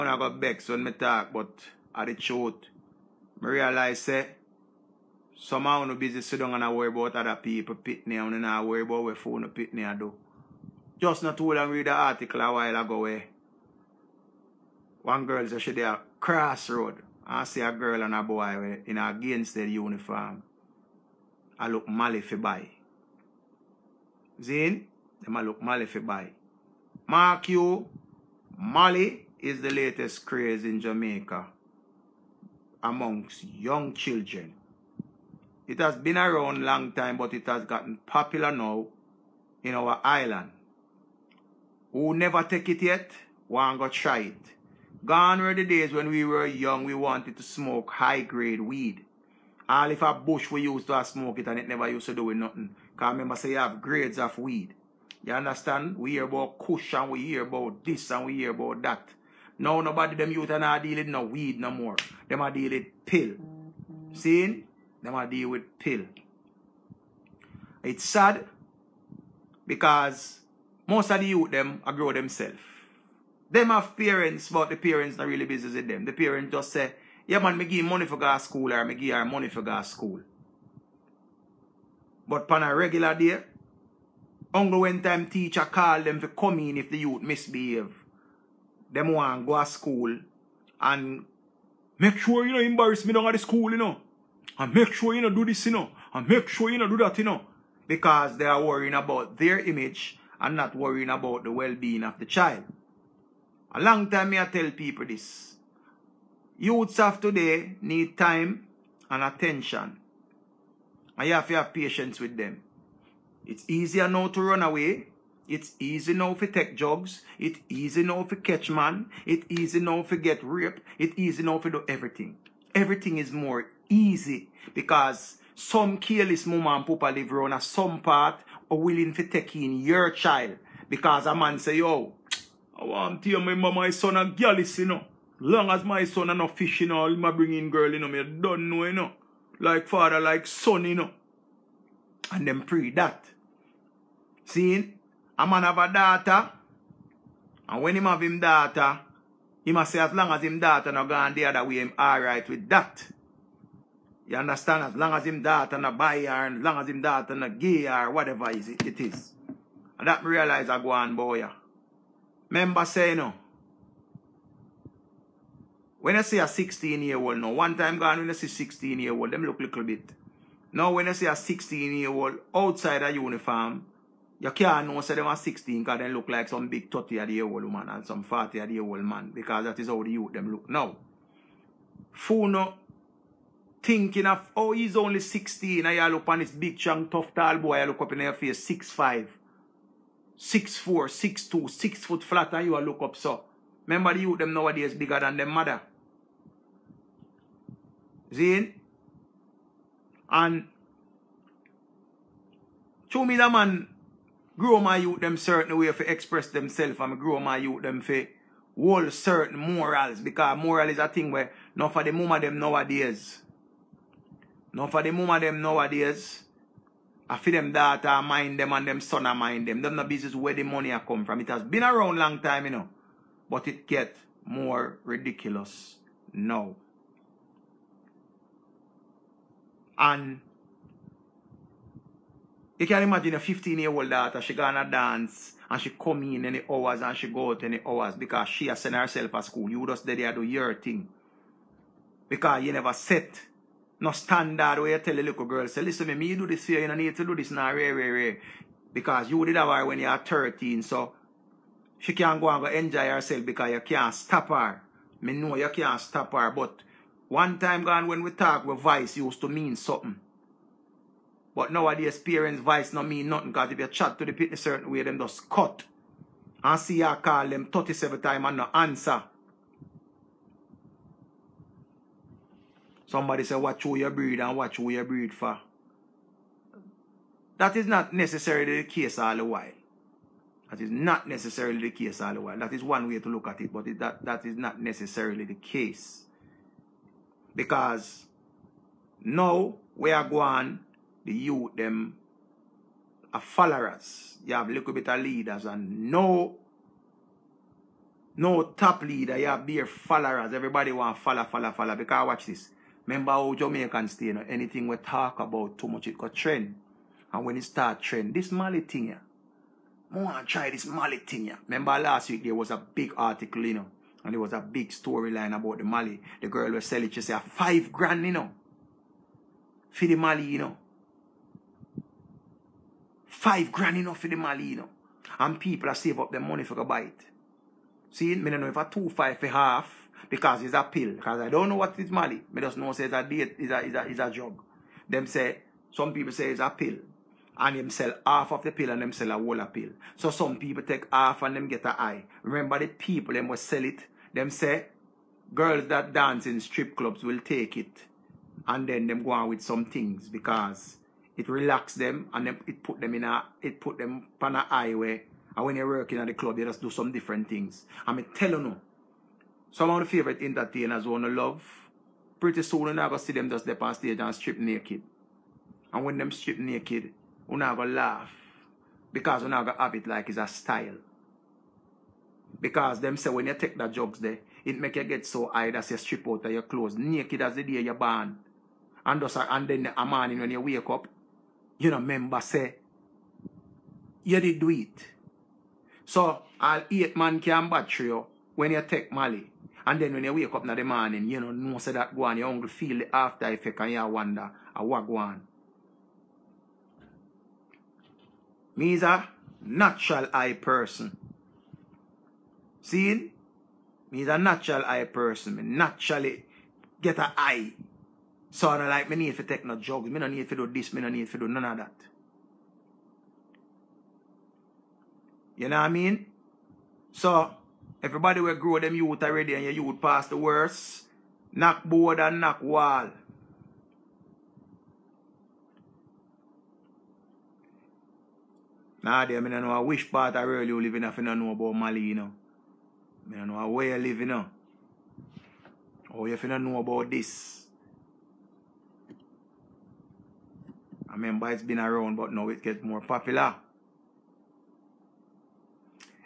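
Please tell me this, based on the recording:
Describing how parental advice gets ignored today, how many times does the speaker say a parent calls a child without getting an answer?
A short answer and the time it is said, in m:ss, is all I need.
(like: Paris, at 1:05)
37, at 4:27.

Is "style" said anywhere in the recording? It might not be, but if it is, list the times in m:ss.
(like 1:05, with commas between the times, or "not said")
6:10.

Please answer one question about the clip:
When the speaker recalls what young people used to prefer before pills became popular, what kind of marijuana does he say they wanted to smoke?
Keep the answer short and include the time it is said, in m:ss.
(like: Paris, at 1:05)
high-grade weed, at 0:47.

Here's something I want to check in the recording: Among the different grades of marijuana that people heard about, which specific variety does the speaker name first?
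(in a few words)
kush.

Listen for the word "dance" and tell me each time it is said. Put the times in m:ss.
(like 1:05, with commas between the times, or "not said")
3:54, 5:46.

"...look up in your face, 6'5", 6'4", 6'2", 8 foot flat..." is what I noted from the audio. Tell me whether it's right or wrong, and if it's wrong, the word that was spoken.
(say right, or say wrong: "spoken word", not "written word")
wrong: "6", not "8".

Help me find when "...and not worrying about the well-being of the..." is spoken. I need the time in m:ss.
1:40.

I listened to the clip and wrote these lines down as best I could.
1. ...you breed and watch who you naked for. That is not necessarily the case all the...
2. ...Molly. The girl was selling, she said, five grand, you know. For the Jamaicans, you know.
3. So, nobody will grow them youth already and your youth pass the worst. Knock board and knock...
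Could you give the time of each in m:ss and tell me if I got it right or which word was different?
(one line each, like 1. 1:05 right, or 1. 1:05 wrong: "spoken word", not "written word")
1. 4:33 wrong: "breed", not "naked"
2. 5:15 wrong: "Molly", not "Jamaicans"
3. 6:57 wrong: "everybody", not "nobody".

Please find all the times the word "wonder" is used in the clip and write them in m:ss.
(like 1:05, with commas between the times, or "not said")
6:34.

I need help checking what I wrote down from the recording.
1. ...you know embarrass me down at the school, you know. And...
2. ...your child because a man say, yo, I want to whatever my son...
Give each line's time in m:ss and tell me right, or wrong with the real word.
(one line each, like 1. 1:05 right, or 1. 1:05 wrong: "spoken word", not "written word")
1. 1:32 right
2. 2:09 wrong: "remember", not "whatever".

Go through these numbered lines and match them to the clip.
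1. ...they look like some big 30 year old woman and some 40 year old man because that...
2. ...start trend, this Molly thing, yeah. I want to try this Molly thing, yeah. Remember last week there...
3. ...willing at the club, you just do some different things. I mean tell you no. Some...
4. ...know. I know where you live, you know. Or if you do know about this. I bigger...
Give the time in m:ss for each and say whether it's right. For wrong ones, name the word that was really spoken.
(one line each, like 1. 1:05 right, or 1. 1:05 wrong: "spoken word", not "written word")
1. 2:55 right
2. 5:07 right
3. 5:55 wrong: "working", not "willing"
4. 7:12 wrong: "remember", not "bigger".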